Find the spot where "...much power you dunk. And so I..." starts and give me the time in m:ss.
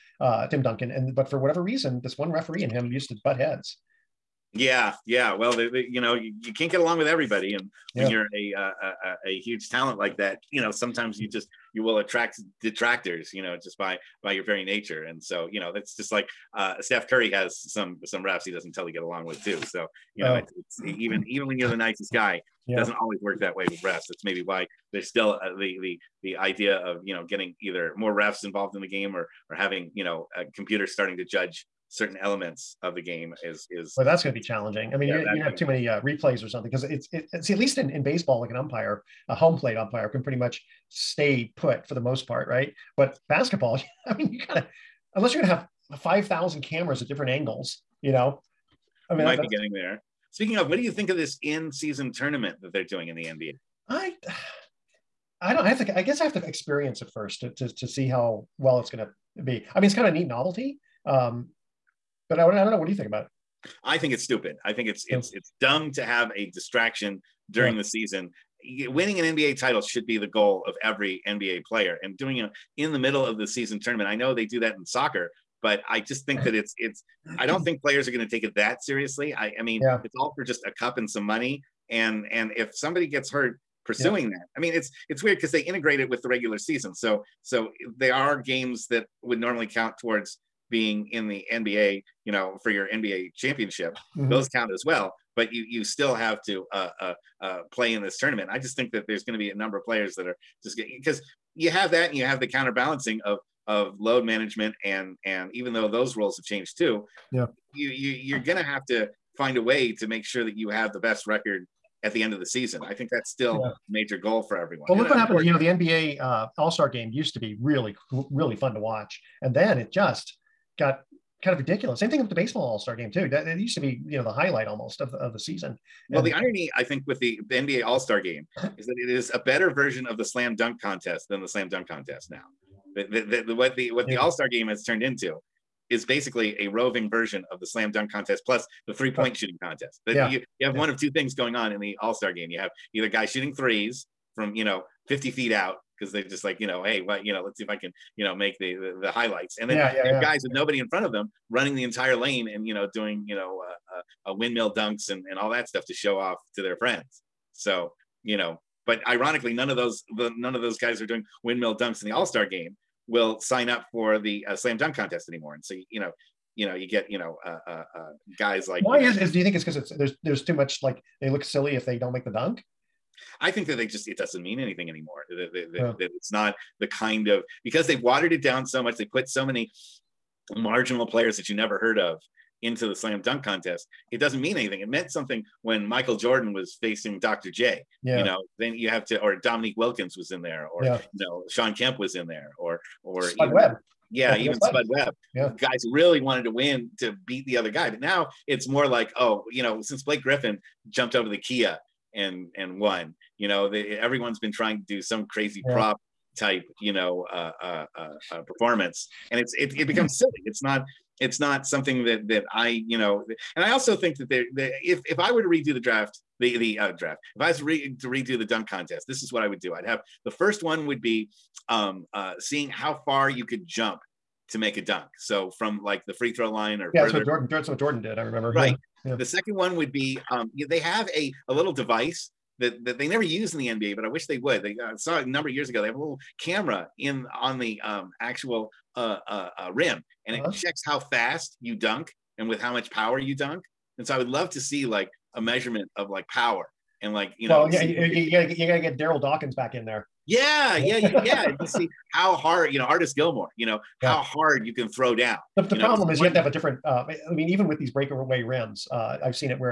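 4:02.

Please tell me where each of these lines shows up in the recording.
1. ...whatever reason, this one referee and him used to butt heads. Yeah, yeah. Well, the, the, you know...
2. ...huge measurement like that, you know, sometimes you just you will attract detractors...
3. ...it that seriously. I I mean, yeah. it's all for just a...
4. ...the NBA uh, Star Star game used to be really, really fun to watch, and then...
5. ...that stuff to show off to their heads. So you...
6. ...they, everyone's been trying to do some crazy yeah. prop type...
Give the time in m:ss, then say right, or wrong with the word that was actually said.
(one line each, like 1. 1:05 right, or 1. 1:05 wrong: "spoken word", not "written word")
1. 0:01 right
2. 0:09 wrong: "talent", not "measurement"
3. 1:18 right
4. 1:55 wrong: "All", not "Star"
5. 2:35 wrong: "friends", not "heads"
6. 3:23 right.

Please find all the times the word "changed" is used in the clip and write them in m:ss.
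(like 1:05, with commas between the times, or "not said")
1:46.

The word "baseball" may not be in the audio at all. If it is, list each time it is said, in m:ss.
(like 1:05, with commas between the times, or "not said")
0:38, 2:02.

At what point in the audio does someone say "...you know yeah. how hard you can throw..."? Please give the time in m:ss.
4:13.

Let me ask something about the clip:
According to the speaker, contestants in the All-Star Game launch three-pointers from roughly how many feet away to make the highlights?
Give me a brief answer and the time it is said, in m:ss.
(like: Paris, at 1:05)
50, at 2:25.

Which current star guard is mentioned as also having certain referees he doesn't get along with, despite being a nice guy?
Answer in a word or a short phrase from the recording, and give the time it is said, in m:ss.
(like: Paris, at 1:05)
Steph Curry, at 0:16.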